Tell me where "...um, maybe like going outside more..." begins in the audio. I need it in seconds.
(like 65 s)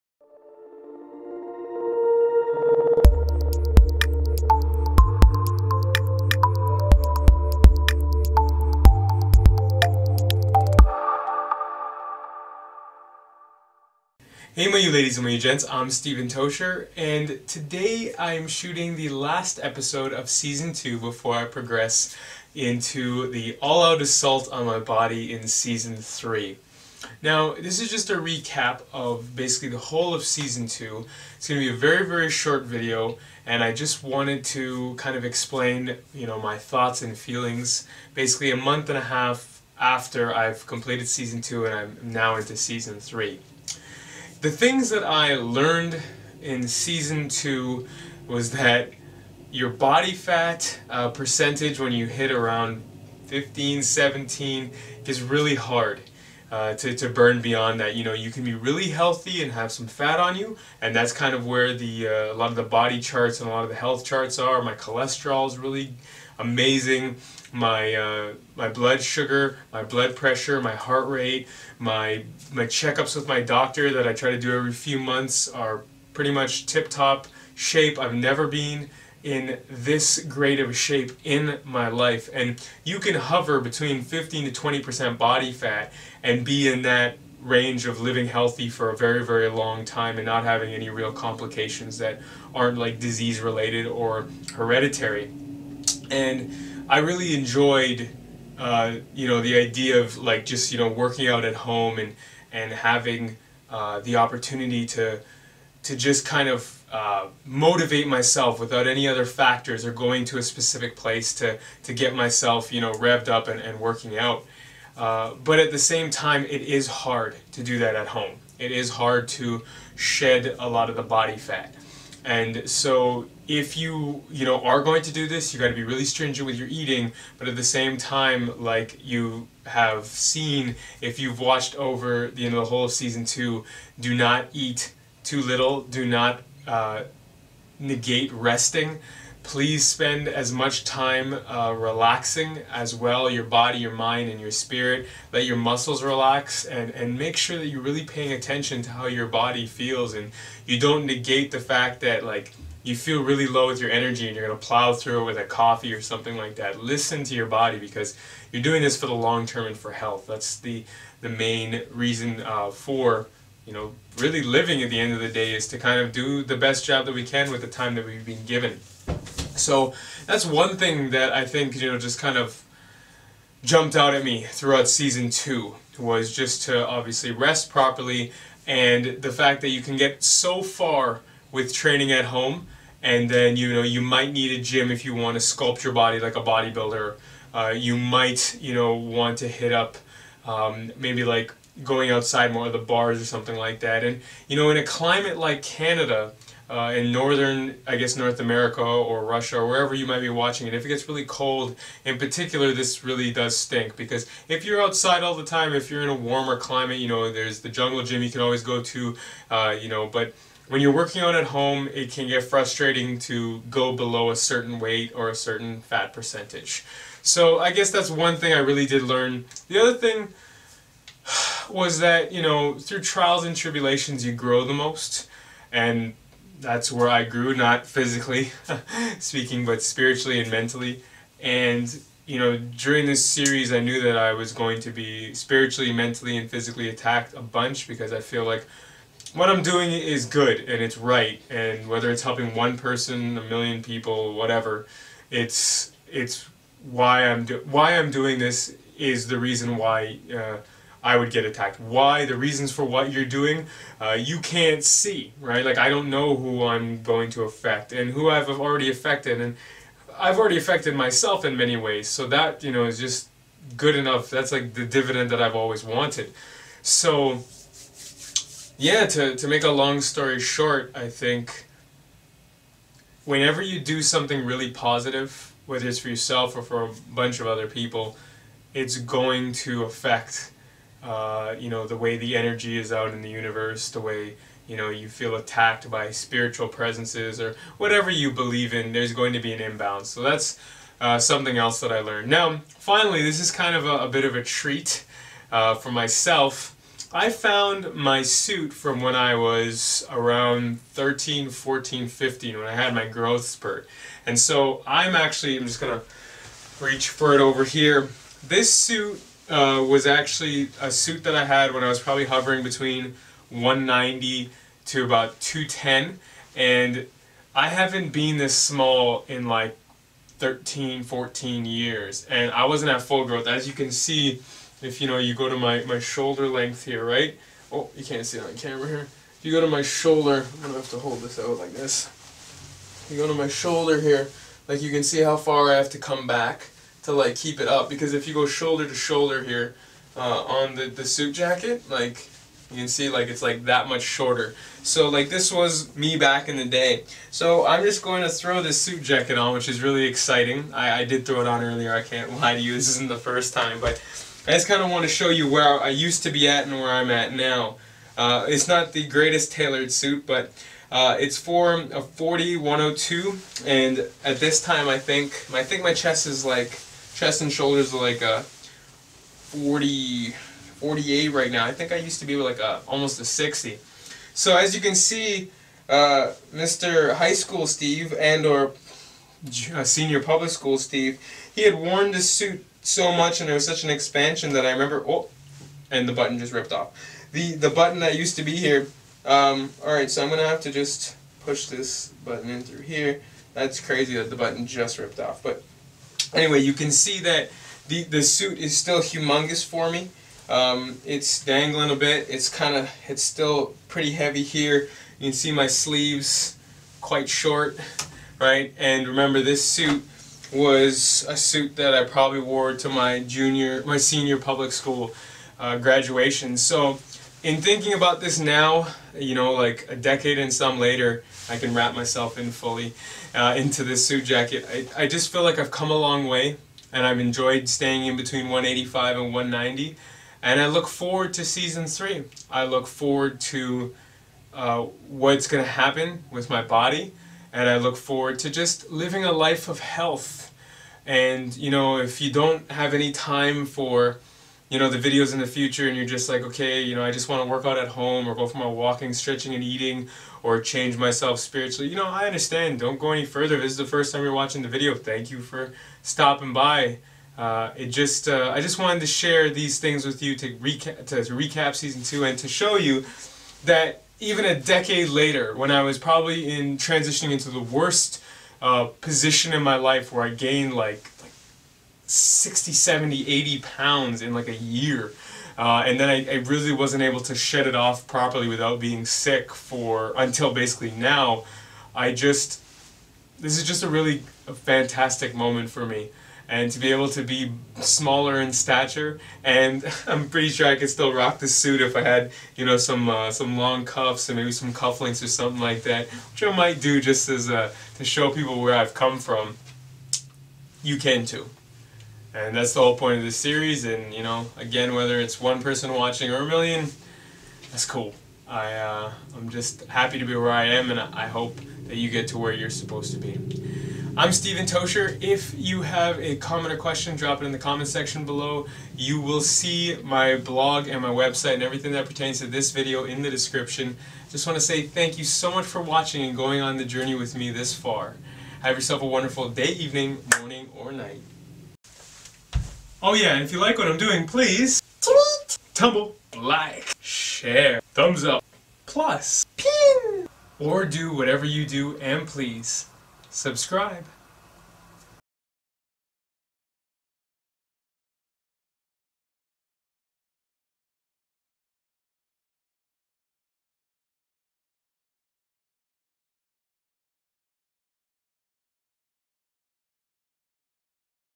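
190 s.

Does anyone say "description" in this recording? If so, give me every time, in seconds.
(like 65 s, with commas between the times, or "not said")
523 s.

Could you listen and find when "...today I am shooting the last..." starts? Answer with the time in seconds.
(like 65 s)
17 s.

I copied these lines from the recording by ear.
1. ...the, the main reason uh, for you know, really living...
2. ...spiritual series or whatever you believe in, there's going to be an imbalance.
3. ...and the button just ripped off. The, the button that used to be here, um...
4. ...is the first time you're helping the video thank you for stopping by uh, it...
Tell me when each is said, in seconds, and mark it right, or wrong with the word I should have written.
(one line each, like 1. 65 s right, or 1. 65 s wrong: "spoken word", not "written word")
1. 160 s right
2. 286 s wrong: "presences", not "series"
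3. 385 s right
4. 453 s wrong: "watching", not "helping".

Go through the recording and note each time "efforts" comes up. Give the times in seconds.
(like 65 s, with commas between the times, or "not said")
not said.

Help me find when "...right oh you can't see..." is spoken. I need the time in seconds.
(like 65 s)
327 s.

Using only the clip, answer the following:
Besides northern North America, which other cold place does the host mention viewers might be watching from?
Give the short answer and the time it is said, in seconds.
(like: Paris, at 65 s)
Russia, at 199 s.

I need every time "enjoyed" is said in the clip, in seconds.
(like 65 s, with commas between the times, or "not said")
97 s, 427 s.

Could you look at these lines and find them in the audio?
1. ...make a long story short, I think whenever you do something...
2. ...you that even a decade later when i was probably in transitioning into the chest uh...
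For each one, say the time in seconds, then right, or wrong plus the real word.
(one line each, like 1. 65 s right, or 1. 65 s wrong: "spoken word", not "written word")
1. 269 s right
2. 462 s wrong: "worst", not "chest".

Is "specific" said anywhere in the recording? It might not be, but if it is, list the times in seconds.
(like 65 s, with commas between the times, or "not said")
110 s.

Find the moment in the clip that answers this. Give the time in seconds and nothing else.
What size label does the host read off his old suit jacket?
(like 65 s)
362 s.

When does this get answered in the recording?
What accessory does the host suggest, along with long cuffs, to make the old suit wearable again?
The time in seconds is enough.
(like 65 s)
494 s.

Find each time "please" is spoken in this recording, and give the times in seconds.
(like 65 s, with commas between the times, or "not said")
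139 s, 534 s, 542 s.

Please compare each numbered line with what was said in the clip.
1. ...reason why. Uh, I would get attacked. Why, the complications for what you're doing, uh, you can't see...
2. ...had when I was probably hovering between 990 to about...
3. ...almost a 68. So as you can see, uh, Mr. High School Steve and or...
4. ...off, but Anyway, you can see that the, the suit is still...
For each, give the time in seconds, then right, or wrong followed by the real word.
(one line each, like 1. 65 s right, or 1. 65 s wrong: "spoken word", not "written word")
1. 249 s wrong: "reasons", not "complications"
2. 311 s wrong: "190", not "990"
3. 372 s wrong: "60", not "68"
4. 395 s right.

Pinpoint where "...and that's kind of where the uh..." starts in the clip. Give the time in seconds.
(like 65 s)
60 s.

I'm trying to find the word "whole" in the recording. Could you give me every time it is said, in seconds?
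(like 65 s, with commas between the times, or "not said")
29 s, 132 s, 502 s.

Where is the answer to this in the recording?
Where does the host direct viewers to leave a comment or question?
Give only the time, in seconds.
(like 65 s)
517 s.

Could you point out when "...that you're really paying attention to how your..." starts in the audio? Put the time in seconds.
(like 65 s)
147 s.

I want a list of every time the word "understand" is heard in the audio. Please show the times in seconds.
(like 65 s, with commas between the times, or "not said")
452 s.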